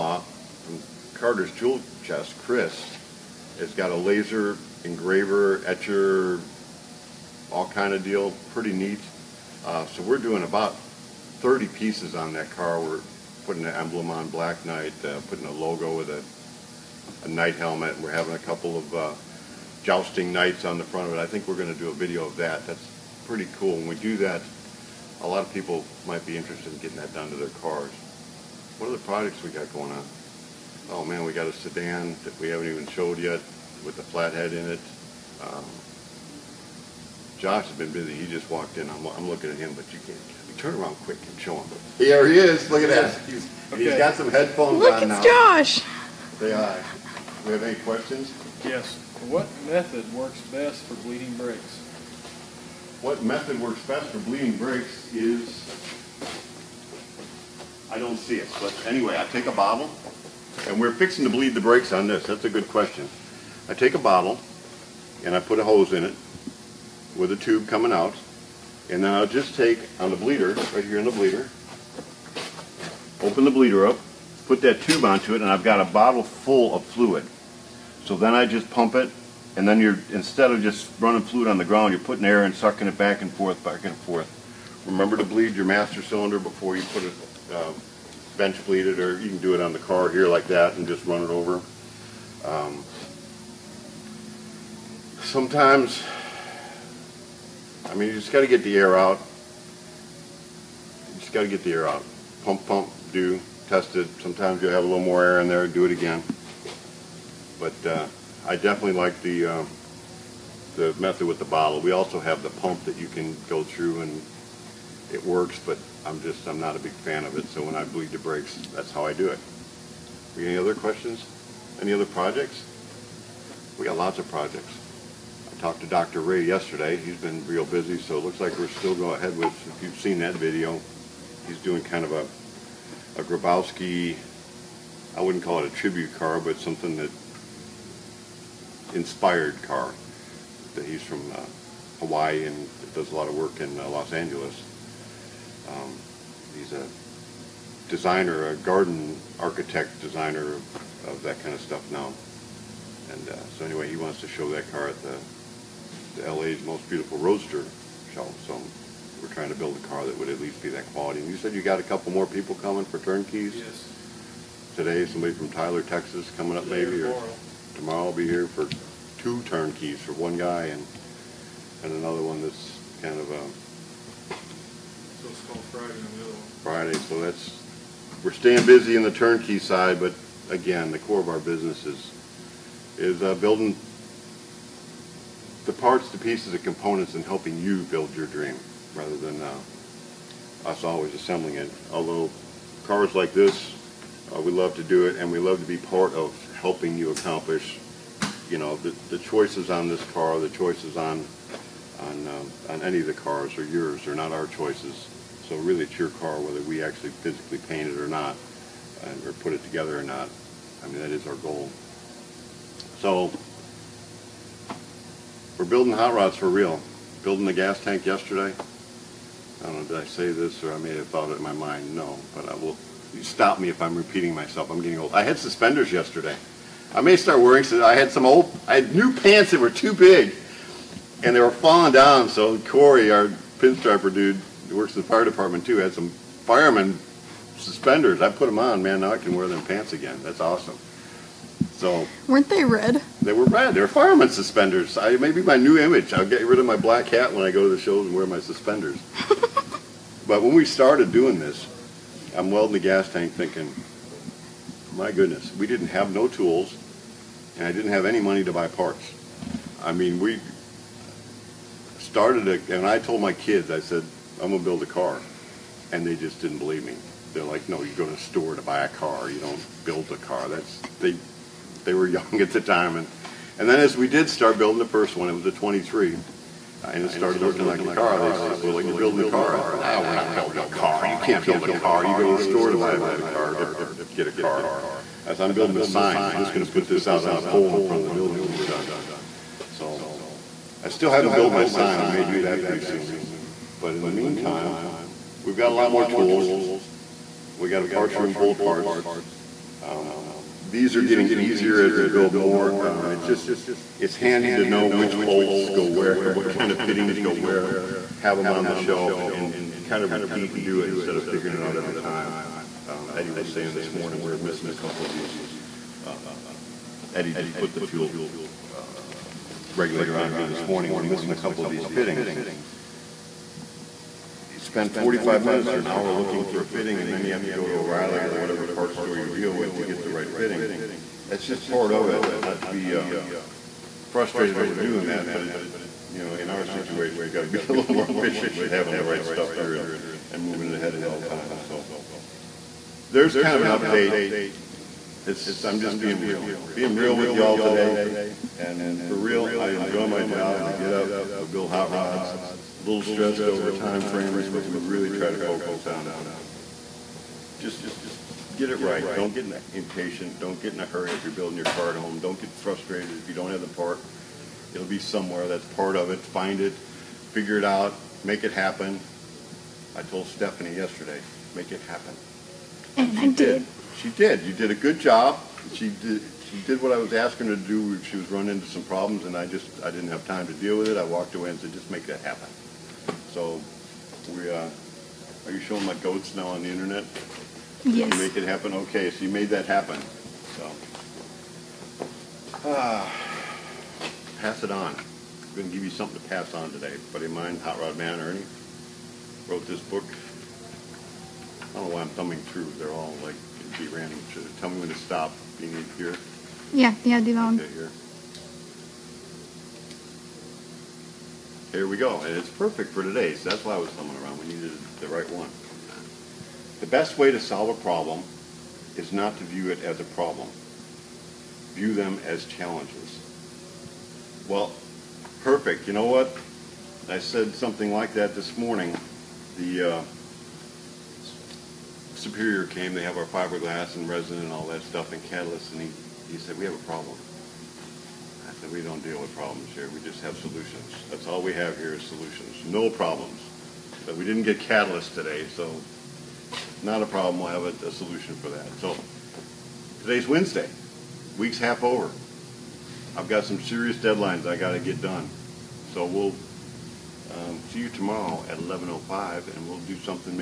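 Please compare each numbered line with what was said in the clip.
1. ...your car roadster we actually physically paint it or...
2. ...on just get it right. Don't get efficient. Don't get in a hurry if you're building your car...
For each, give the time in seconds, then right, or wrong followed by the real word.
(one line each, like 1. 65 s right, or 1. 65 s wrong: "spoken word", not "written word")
1. 205 s wrong: "whether", not "roadster"
2. 355 s wrong: "impatient", not "efficient".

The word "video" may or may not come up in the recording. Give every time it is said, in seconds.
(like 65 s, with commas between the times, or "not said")
21 s, 130 s.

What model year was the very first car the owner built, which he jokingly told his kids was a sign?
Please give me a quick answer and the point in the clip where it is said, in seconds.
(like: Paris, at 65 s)
23, at 275 s.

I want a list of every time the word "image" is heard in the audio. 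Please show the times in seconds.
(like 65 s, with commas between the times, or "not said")
245 s.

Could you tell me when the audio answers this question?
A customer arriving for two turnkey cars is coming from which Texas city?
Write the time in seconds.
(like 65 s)
165 s.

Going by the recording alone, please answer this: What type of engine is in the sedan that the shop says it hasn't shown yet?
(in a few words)
Flathead.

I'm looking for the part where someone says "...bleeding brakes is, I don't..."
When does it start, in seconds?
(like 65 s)
54 s.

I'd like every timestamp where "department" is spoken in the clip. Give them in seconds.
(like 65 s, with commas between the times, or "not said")
235 s.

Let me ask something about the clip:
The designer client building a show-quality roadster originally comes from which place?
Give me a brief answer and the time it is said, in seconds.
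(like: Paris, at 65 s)
Hawaii, at 141 s.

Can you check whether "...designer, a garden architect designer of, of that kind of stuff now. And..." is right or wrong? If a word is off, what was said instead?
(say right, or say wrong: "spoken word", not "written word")
right.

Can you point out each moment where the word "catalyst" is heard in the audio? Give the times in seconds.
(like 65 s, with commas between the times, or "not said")
435 s, 444 s.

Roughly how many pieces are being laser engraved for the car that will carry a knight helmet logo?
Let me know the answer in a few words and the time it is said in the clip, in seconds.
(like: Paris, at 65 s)
30, at 10 s.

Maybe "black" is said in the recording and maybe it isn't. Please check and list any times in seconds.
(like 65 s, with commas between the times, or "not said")
14 s, 246 s.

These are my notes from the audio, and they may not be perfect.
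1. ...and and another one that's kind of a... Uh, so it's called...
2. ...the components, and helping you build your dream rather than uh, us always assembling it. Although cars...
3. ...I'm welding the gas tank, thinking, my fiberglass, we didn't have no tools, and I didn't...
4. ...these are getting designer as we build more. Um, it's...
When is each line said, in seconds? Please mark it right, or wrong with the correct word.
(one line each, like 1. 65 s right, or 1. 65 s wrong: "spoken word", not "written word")
1. 170 s right
2. 186 s right
3. 252 s wrong: "goodness", not "fiberglass"
4. 300 s wrong: "easier", not "designer".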